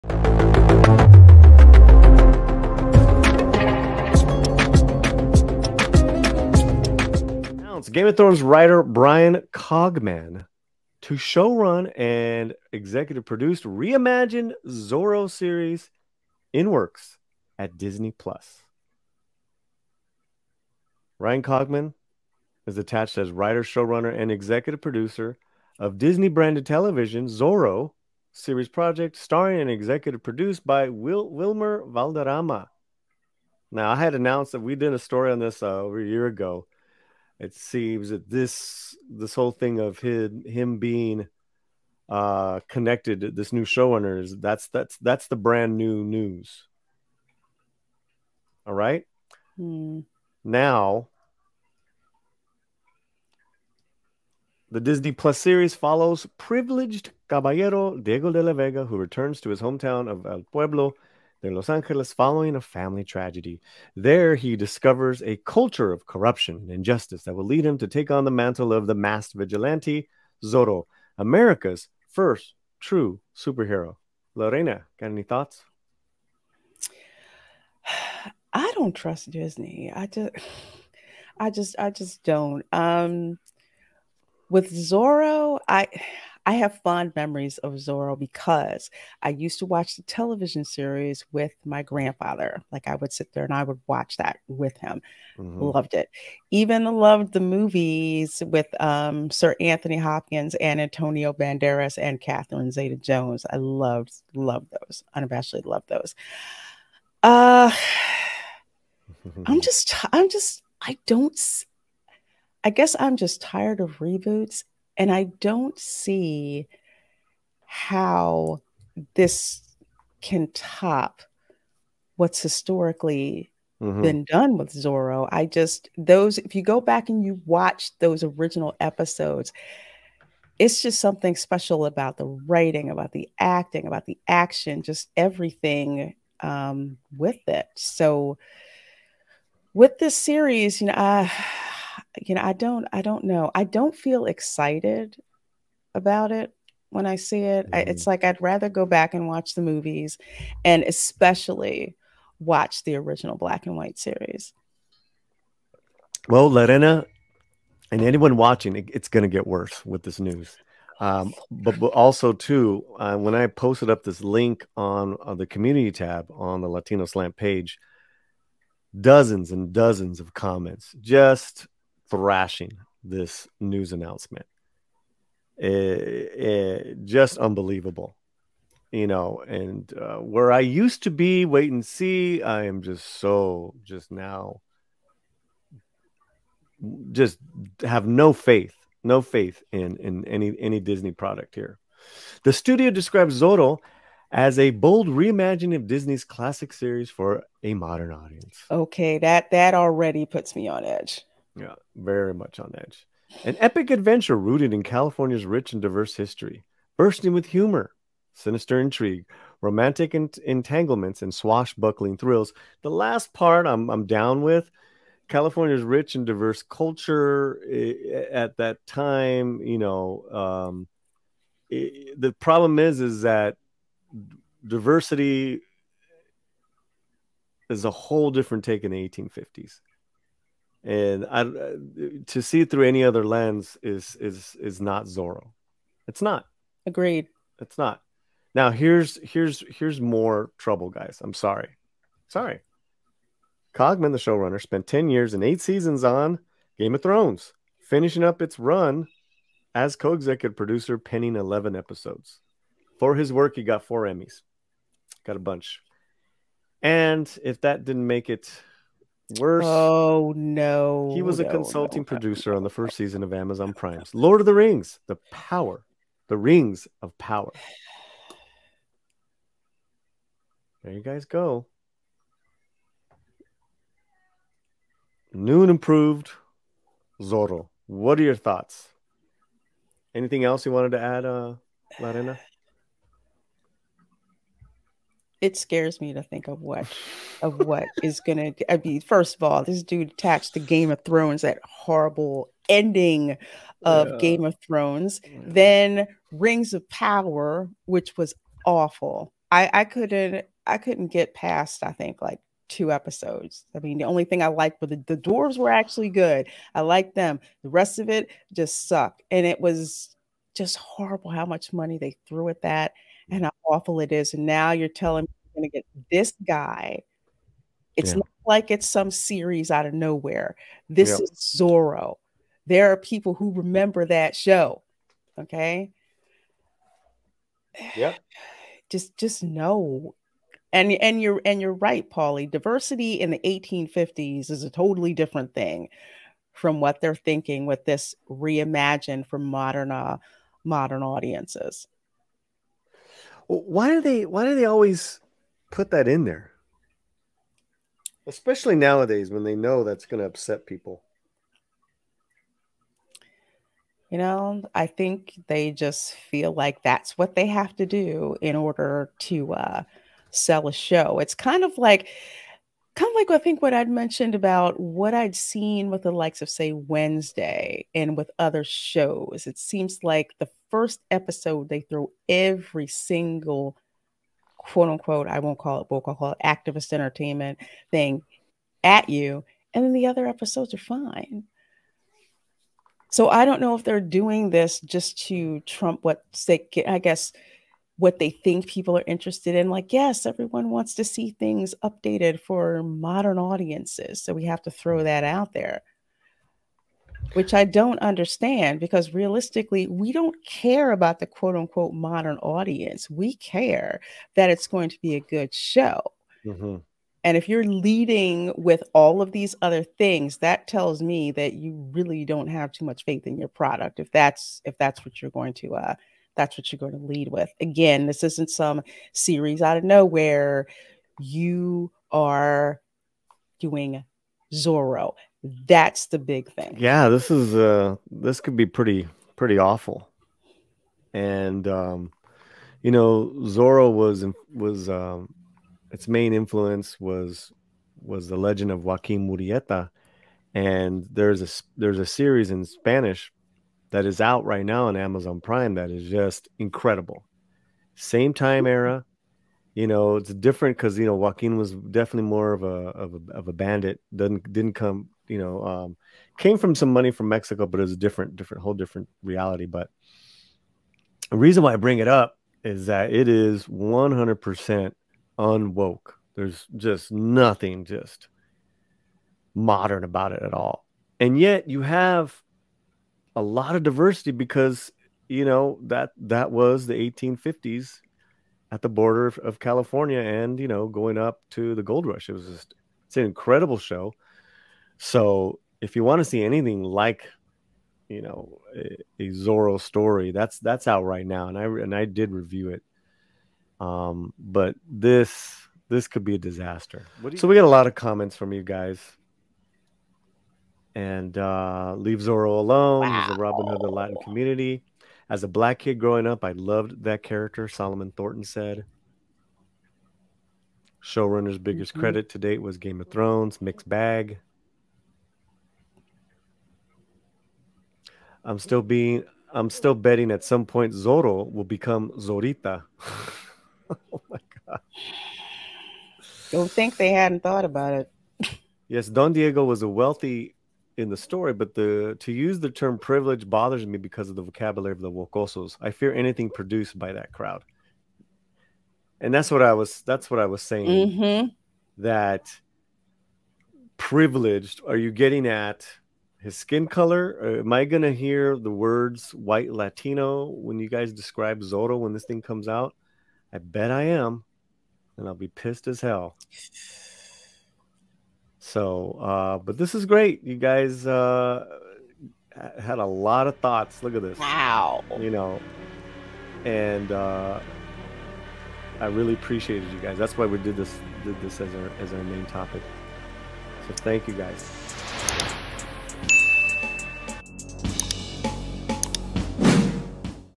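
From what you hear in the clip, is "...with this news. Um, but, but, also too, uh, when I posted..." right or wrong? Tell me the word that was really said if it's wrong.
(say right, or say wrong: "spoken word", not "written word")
right.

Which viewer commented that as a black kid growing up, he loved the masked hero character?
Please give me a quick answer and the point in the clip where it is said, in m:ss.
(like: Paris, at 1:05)
Solomon Thornton, at 8:27.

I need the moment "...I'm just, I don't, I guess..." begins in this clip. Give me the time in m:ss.
1:50.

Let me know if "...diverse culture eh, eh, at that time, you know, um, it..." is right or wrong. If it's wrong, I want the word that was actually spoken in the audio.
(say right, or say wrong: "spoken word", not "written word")
right.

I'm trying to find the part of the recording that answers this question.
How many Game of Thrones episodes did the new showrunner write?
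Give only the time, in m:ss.
4:11.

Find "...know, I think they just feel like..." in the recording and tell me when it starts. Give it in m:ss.
5:54.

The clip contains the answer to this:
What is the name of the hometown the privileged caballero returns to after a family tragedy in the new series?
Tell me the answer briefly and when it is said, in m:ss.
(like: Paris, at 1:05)
El Pueblo, at 1:00.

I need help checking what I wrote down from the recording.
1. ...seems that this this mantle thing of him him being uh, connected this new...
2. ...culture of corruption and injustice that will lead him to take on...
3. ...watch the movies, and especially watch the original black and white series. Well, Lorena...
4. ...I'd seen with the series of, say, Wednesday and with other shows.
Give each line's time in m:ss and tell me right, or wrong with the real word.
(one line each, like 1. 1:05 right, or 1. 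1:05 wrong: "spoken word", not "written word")
1. 0:37 wrong: "whole", not "mantle"
2. 1:05 right
3. 2:29 right
4. 6:05 wrong: "likes", not "series".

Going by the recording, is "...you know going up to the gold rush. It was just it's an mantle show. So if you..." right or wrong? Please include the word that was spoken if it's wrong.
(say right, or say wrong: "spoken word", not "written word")
wrong: "incredible", not "mantle".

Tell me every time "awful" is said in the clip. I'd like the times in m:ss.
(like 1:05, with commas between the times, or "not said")
4:58, 5:13, 7:09.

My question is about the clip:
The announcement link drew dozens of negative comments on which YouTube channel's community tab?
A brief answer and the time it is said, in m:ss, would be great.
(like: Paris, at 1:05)
Latino Slant, at 2:46.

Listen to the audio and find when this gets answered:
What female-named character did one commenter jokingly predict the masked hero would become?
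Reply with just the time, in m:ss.
8:42.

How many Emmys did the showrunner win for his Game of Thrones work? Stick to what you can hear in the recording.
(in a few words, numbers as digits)
4.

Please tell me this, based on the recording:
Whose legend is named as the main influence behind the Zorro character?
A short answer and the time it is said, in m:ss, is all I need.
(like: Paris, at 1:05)
Joaquin Murieta, at 7:18.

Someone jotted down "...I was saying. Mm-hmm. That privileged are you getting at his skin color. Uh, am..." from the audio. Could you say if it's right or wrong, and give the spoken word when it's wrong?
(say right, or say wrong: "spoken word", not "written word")
right.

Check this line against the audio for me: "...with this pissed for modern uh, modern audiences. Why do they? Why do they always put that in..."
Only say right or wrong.
wrong.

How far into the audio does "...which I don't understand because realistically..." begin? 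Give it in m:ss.
6:37.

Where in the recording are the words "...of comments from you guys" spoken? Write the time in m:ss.
8:17.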